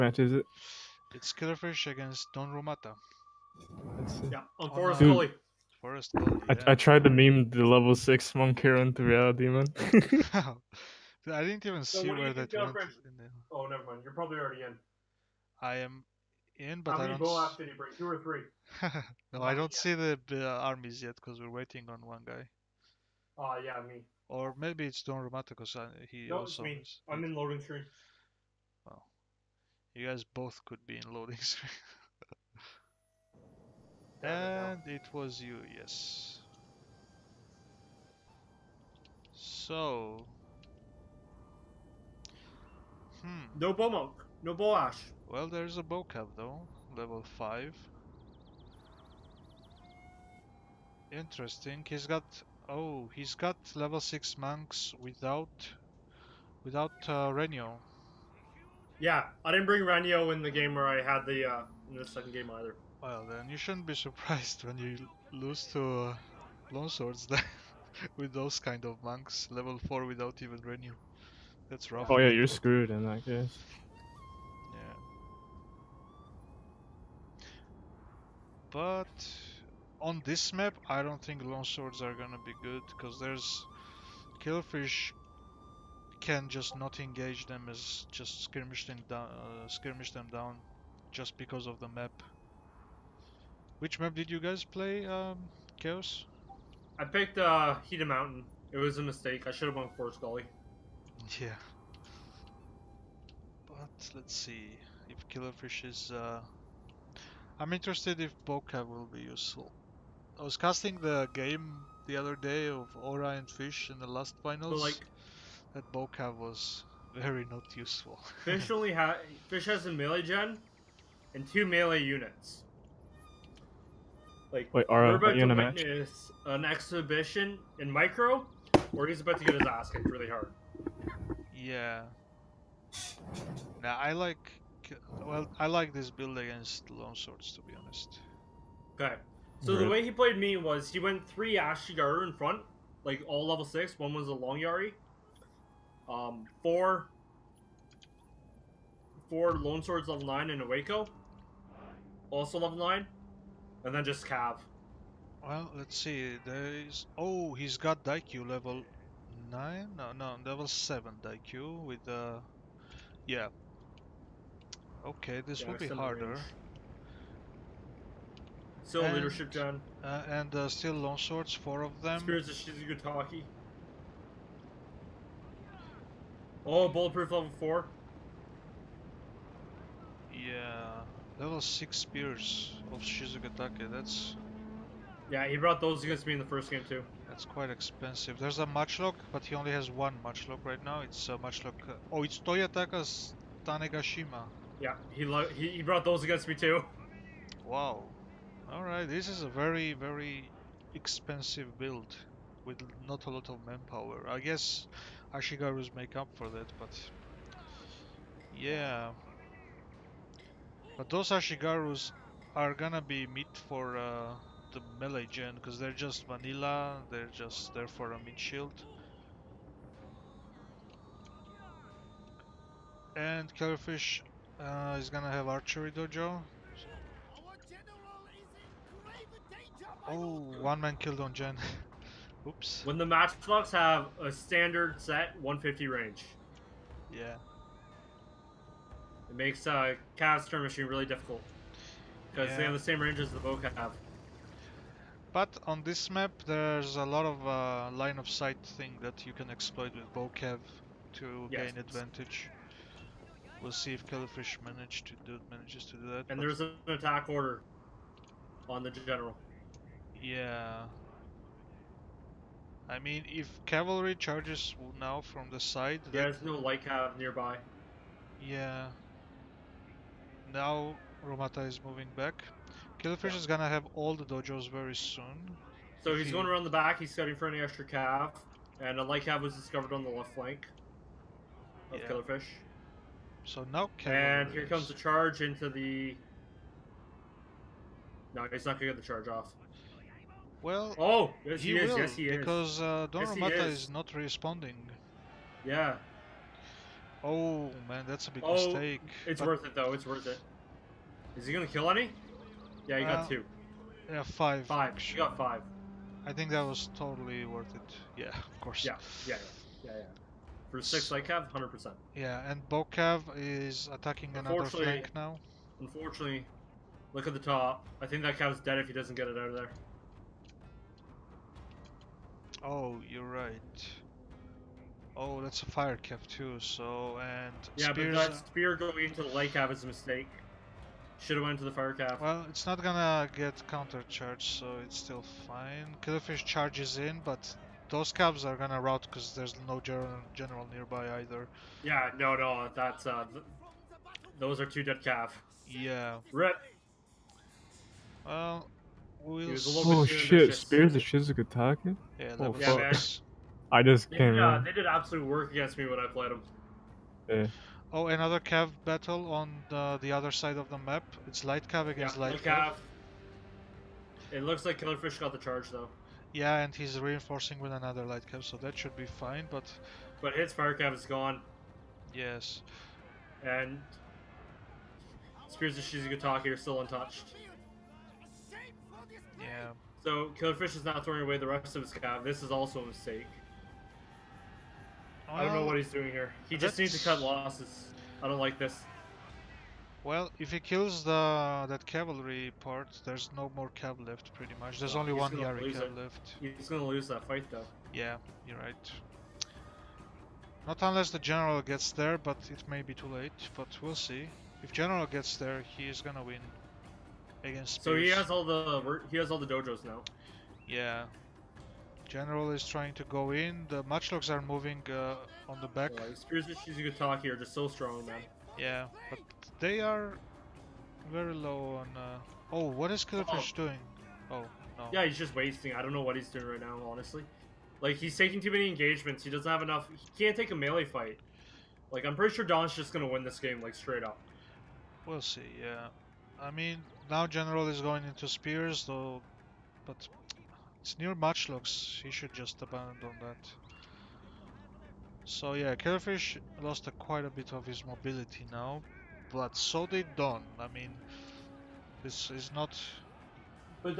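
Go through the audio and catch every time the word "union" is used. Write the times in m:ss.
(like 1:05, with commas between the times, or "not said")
not said.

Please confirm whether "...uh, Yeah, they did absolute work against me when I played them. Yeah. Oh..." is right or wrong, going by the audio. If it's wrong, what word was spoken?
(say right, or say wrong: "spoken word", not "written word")
right.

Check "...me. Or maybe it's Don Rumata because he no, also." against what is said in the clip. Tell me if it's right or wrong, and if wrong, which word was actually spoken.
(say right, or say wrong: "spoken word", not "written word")
right.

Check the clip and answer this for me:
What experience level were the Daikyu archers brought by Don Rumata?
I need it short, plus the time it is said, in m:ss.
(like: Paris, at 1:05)
7, at 2:40.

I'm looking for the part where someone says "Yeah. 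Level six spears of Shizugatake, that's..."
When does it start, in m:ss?
3:00.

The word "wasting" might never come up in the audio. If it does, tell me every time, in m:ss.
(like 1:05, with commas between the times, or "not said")
7:05.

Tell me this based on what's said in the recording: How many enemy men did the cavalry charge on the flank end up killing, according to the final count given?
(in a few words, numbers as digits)
5.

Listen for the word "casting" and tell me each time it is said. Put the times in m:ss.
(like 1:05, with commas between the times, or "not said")
1:50.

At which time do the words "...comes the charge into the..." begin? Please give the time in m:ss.
4:44.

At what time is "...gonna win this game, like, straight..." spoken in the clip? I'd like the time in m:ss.
7:12.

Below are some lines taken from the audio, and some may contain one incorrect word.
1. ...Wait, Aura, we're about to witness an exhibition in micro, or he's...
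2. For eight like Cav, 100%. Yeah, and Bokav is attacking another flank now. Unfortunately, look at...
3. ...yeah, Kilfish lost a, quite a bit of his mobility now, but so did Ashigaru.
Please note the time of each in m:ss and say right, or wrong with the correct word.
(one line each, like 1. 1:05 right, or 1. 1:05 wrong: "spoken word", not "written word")
1. 2:04 right
2. 5:10 wrong: "six", not "eight"
3. 7:25 wrong: "Don", not "Ashigaru".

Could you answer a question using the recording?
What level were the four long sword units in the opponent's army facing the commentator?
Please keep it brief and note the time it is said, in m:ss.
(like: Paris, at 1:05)
9, at 2:29.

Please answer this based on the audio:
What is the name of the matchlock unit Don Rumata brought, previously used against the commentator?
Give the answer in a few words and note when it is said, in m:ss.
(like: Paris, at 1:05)
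Toyotaka's Tanegashima, at 3:12.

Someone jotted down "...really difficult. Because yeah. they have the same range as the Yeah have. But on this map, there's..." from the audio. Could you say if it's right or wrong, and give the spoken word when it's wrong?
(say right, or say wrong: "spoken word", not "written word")
wrong: "Boca", not "Yeah".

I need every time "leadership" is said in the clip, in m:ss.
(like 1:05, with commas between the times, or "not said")
2:49.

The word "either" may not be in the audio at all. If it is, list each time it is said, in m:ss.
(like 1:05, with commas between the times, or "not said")
1:02, 5:41.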